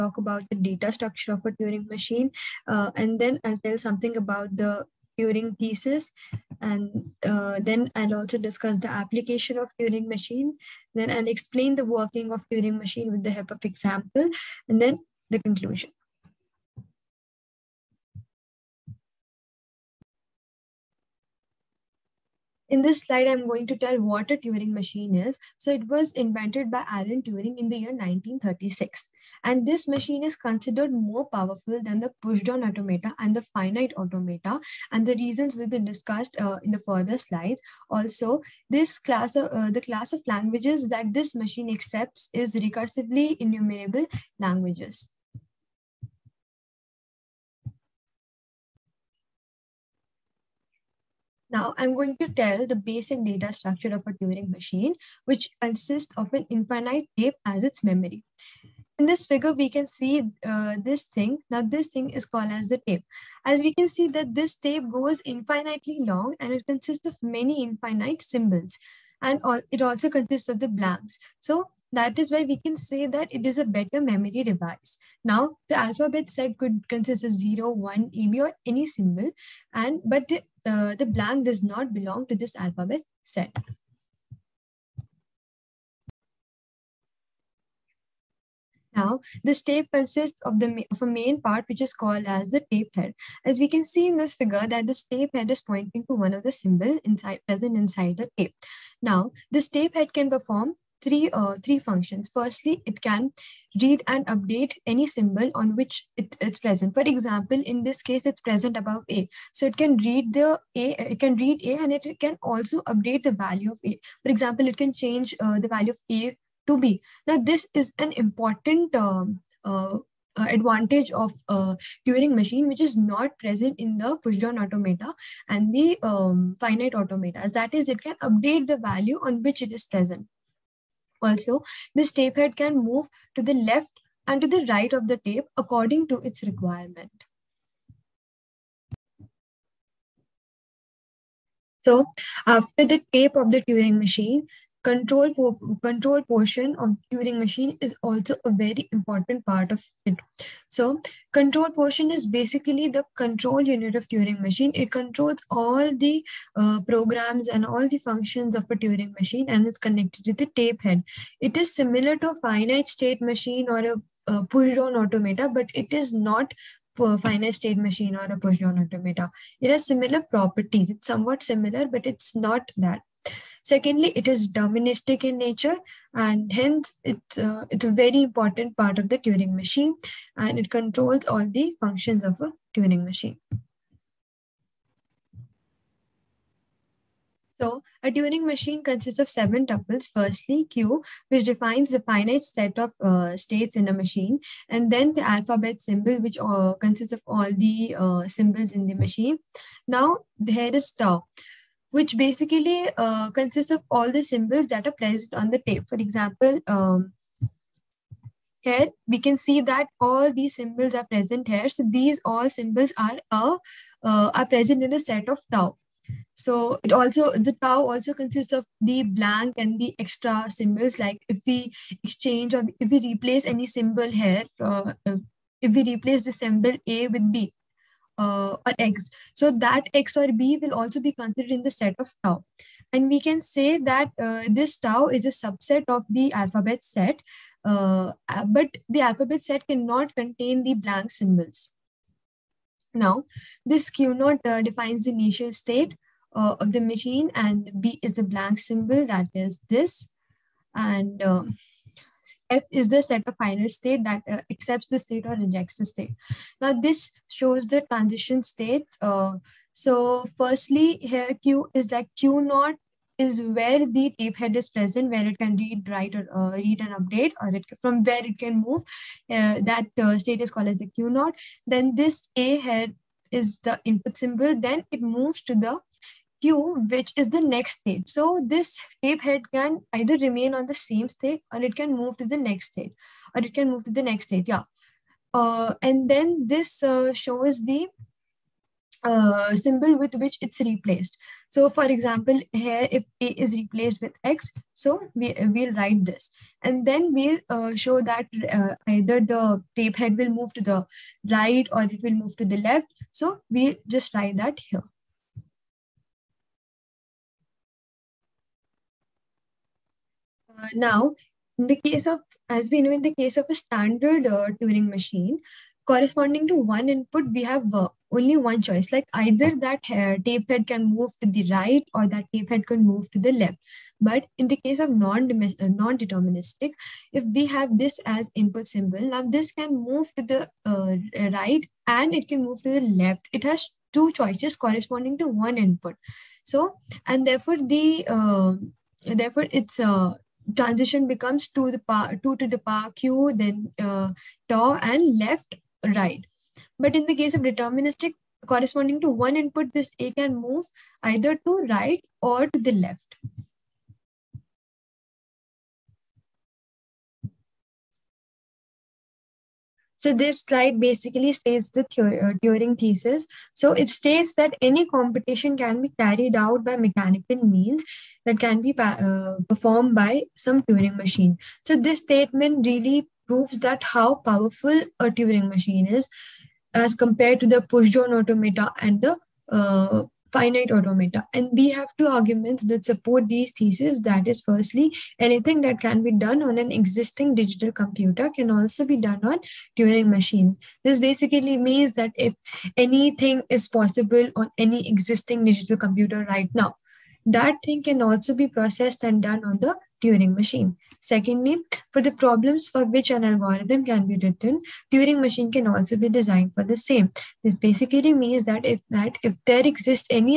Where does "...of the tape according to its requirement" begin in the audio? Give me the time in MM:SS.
02:14.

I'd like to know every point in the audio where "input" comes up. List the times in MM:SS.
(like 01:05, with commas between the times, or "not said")
04:33, 05:16, 05:28, 05:35, 05:49.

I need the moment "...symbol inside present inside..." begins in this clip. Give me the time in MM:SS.
01:36.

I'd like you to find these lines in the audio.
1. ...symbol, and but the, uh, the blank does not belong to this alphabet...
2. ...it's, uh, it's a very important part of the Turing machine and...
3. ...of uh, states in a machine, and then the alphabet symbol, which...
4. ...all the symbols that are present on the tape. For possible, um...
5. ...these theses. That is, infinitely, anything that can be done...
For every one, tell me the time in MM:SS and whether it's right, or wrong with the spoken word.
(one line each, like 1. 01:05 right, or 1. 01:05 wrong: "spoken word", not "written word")
1. 01:18 right
2. 02:57 right
3. 03:12 right
4. 03:23 wrong: "example", not "possible"
5. 06:23 wrong: "firstly", not "infinitely".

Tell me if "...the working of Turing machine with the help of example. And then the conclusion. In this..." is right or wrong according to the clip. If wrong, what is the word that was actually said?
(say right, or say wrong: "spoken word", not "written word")
right.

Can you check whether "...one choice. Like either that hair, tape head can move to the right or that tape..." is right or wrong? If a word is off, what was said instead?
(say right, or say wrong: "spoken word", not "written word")
right.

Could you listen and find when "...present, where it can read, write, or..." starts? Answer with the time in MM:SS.
04:24.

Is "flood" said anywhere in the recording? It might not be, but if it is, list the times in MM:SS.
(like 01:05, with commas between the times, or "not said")
not said.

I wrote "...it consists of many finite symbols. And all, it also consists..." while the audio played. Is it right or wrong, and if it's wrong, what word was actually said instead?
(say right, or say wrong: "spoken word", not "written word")
wrong: "infinite", not "finite".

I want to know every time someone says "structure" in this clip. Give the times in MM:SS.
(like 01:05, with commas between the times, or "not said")
00:00, 00:53.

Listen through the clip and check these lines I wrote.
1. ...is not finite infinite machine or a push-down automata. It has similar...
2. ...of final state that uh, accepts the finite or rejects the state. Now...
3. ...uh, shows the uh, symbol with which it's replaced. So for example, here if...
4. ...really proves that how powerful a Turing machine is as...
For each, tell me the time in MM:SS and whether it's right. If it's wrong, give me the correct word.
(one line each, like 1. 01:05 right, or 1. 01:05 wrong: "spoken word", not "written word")
1. 02:45 wrong: "state", not "infinite"
2. 04:13 wrong: "state", not "finite"
3. 04:46 right
4. 06:12 right.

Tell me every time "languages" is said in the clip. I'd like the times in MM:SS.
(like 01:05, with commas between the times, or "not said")
00:40, 00:44.